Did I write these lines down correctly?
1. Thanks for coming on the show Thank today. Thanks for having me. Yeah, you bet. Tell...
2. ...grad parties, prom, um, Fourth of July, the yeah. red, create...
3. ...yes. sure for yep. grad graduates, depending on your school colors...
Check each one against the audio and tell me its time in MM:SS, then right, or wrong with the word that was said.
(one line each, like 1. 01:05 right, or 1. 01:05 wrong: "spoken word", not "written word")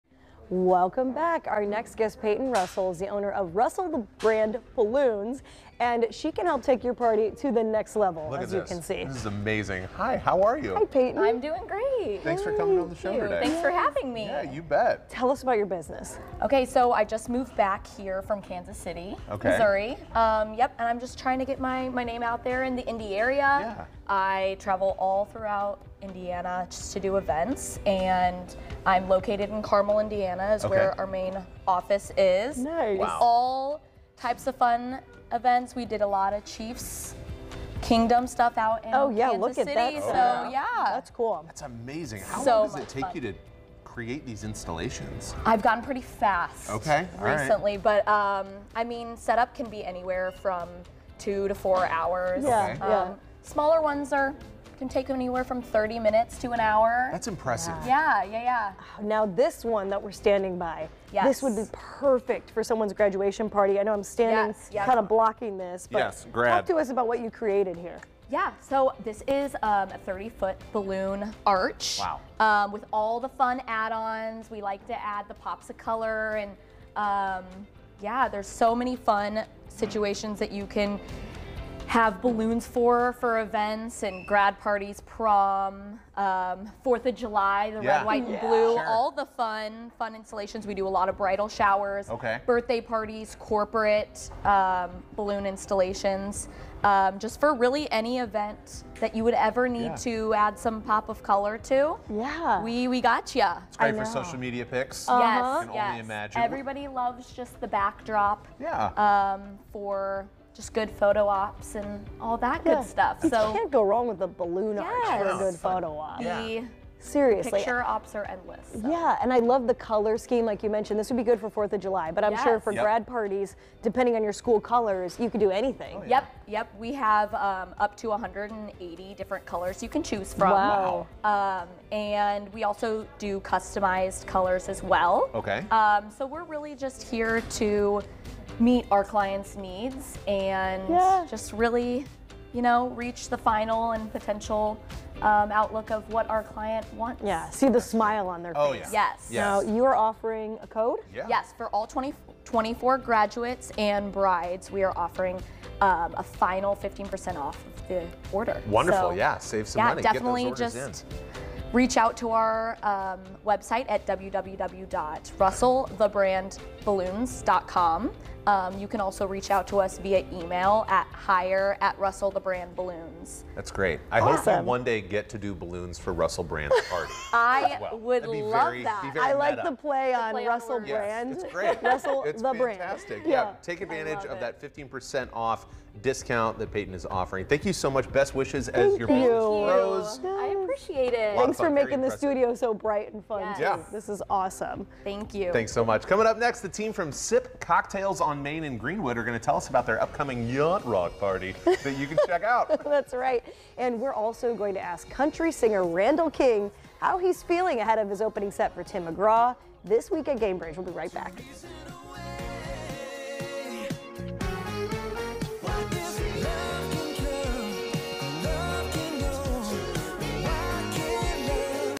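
1. 00:12 right
2. 01:24 wrong: "white", not "create"
3. 02:02 wrong: "parties", not "graduates".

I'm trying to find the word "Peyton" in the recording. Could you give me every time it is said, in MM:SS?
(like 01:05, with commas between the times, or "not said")
00:02, 00:10, 03:06.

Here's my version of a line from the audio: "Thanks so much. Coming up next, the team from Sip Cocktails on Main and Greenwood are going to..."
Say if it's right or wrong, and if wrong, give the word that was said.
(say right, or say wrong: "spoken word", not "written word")
right.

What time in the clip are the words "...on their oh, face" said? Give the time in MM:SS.
02:28.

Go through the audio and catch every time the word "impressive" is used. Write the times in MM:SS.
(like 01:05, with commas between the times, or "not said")
00:57.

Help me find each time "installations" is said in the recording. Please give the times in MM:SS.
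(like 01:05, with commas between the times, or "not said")
00:44, 01:30, 01:35.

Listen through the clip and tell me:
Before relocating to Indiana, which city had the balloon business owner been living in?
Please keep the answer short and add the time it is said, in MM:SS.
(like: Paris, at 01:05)
Kansas City, at 00:18.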